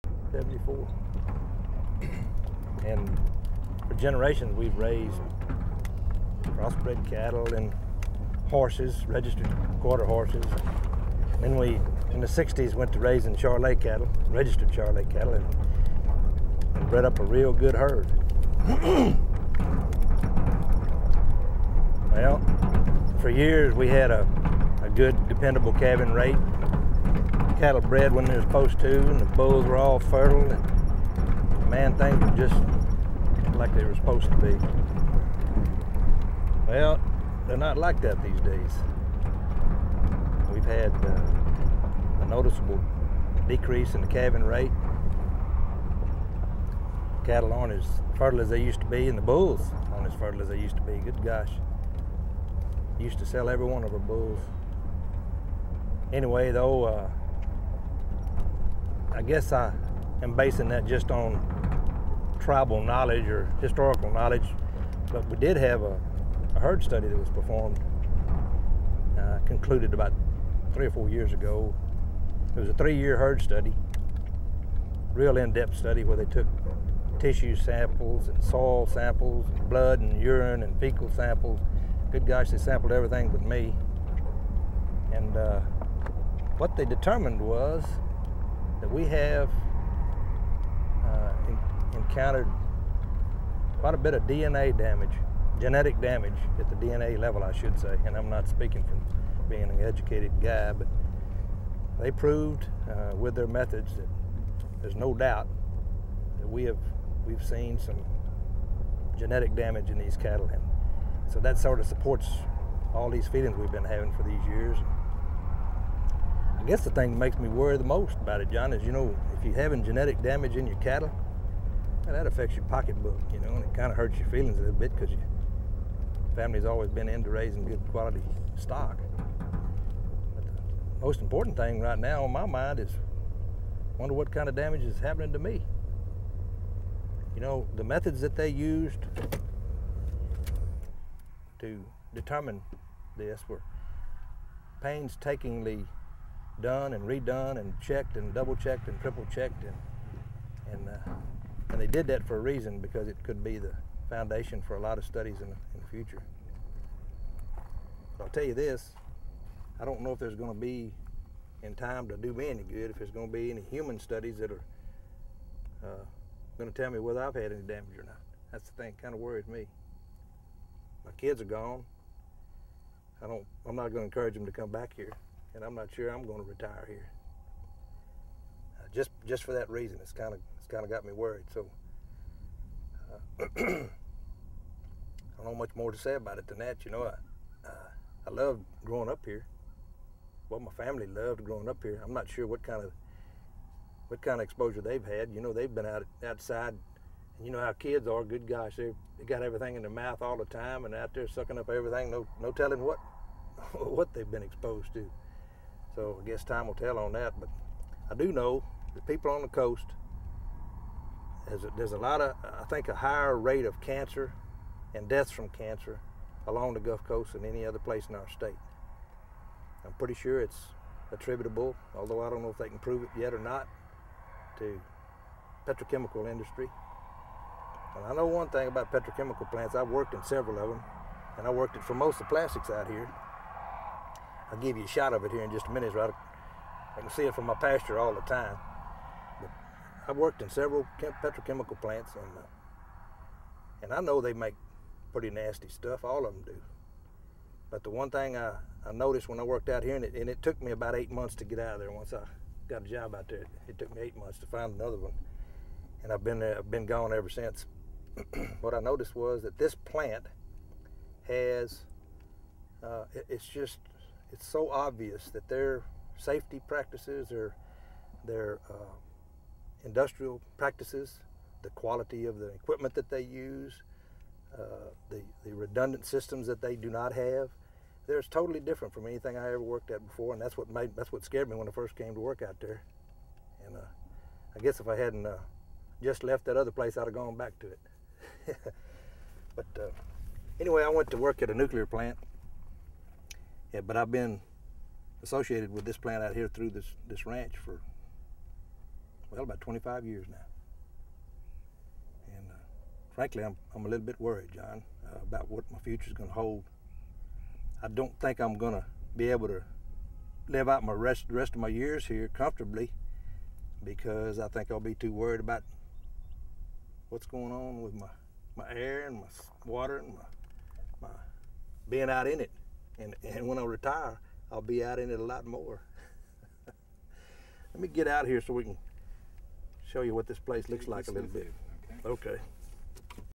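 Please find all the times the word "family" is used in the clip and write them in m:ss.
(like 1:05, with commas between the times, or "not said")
2:06, 3:10.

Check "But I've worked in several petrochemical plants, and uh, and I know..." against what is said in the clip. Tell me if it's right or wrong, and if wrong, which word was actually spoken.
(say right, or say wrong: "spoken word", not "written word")
right.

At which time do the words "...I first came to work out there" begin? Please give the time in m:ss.
4:41.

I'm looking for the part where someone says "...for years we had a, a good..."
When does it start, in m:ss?
0:23.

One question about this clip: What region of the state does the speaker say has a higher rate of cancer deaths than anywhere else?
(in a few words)
Gulf Coast.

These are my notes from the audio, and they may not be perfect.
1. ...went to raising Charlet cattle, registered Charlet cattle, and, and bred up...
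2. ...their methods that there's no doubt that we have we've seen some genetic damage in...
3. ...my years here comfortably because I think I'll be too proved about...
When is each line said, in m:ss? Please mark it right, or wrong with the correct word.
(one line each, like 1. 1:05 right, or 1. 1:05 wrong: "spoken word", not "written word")
1. 0:12 right
2. 1:43 right
3. 5:11 wrong: "worried", not "proved".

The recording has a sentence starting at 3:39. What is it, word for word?
I'm pretty sure it's attributable, although I don't know if they can prove it yet or not, to petrochemical industry.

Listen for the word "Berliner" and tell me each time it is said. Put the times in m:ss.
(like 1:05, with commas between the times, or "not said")
not said.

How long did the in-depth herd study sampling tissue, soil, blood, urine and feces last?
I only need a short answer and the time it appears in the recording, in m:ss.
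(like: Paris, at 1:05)
3 years, at 1:12.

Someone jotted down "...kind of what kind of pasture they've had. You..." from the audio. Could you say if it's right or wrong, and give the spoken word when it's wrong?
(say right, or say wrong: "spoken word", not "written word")
wrong: "exposure", not "pasture".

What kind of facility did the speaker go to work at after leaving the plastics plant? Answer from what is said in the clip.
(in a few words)
nuclear plant.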